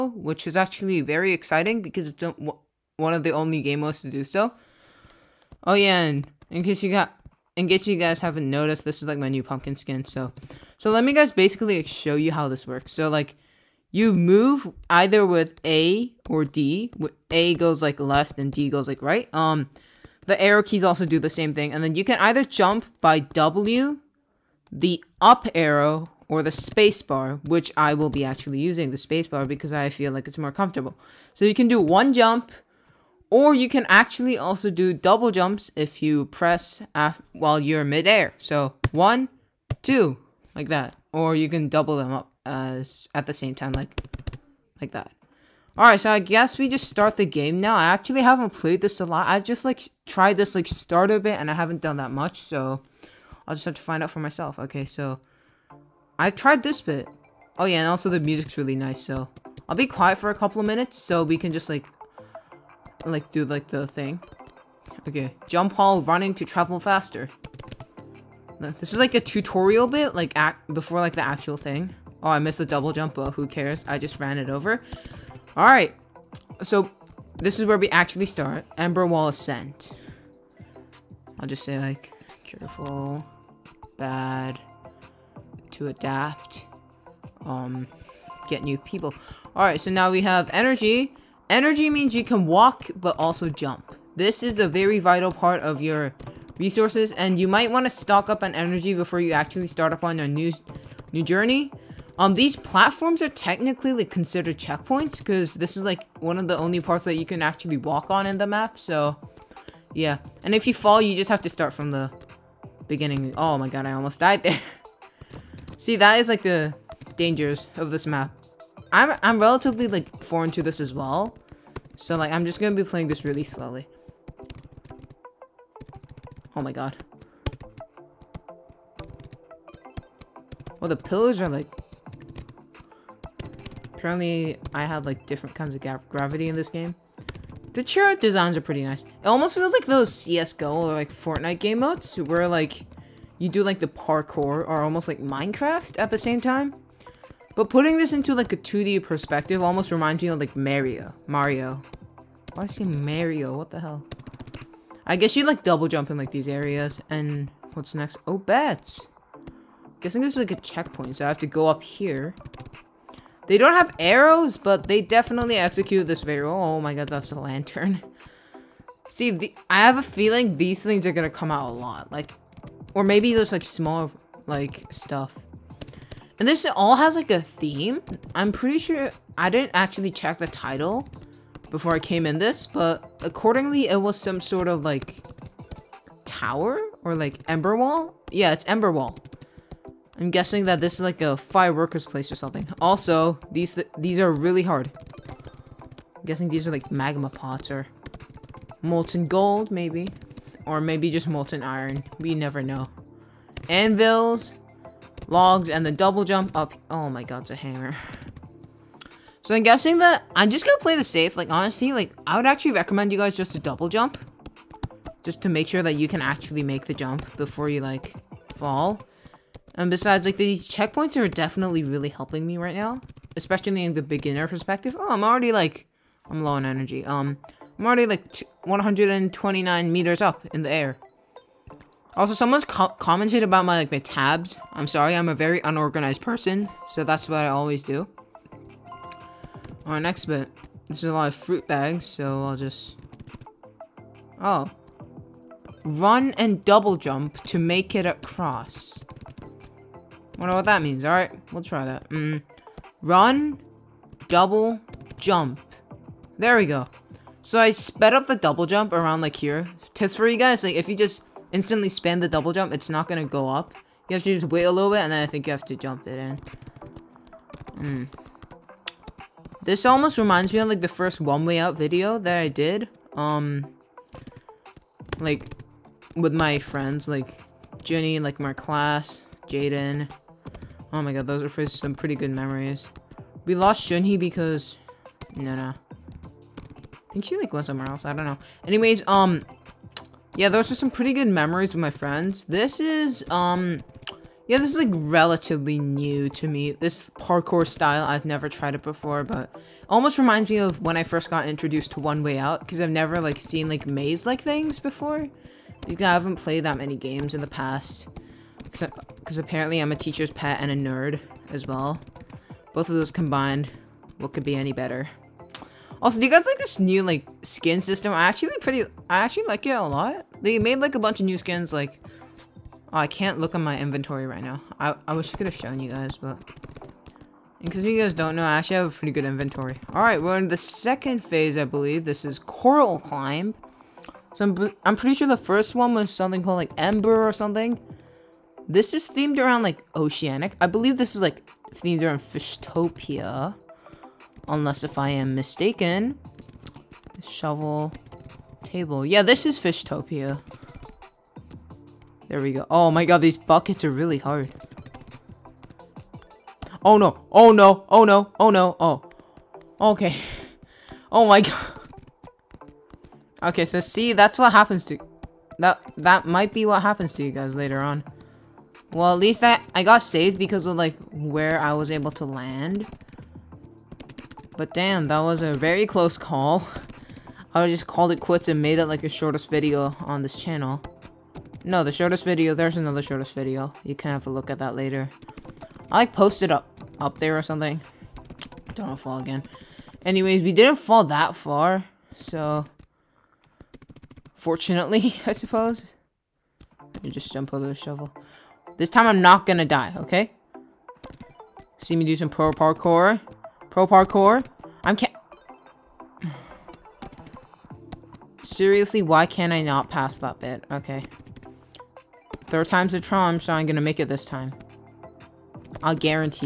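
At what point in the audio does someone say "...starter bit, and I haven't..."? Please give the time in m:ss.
0:50.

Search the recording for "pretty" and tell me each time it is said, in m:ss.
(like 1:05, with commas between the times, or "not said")
2:18, 2:58, 4:41, 4:50, 5:18, 5:28, 5:34.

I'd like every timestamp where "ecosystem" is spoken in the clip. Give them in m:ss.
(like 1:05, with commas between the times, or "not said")
not said.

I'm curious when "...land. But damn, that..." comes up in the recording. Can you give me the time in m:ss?
6:12.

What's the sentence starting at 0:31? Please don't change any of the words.
So you can do one jump, or you can actually also do double jumps if you press while you're midair.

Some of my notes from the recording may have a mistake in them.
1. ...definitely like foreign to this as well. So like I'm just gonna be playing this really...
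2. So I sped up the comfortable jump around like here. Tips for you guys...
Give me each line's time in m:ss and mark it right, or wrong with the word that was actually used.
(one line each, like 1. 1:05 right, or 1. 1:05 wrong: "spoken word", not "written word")
1. 1:59 wrong: "relatively", not "definitely"
2. 4:17 wrong: "double", not "comfortable".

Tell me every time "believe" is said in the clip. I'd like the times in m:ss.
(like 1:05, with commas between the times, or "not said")
5:31, 5:40.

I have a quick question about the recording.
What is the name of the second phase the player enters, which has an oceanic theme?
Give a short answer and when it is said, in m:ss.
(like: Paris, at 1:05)
Coral Climb, at 5:32.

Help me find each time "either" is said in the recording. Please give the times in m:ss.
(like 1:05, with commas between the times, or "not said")
0:14, 0:22.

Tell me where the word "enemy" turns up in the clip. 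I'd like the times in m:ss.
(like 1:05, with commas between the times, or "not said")
not said.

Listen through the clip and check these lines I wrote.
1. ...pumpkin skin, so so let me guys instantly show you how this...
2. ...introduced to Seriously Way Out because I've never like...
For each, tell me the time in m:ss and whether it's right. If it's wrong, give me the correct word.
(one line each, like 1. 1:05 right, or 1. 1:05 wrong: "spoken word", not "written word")
1. 0:09 wrong: "basically", not "instantly"
2. 5:01 wrong: "One", not "Seriously".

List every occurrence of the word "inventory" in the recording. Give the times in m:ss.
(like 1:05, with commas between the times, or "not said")
5:23, 5:29.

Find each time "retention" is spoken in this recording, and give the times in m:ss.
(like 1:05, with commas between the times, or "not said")
not said.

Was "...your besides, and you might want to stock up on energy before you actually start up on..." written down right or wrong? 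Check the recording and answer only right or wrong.
wrong.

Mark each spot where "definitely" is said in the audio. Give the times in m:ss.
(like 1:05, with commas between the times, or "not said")
2:45, 3:41.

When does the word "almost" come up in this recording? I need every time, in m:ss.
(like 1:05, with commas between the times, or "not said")
1:53, 2:19, 2:24, 2:29, 4:29, 4:59.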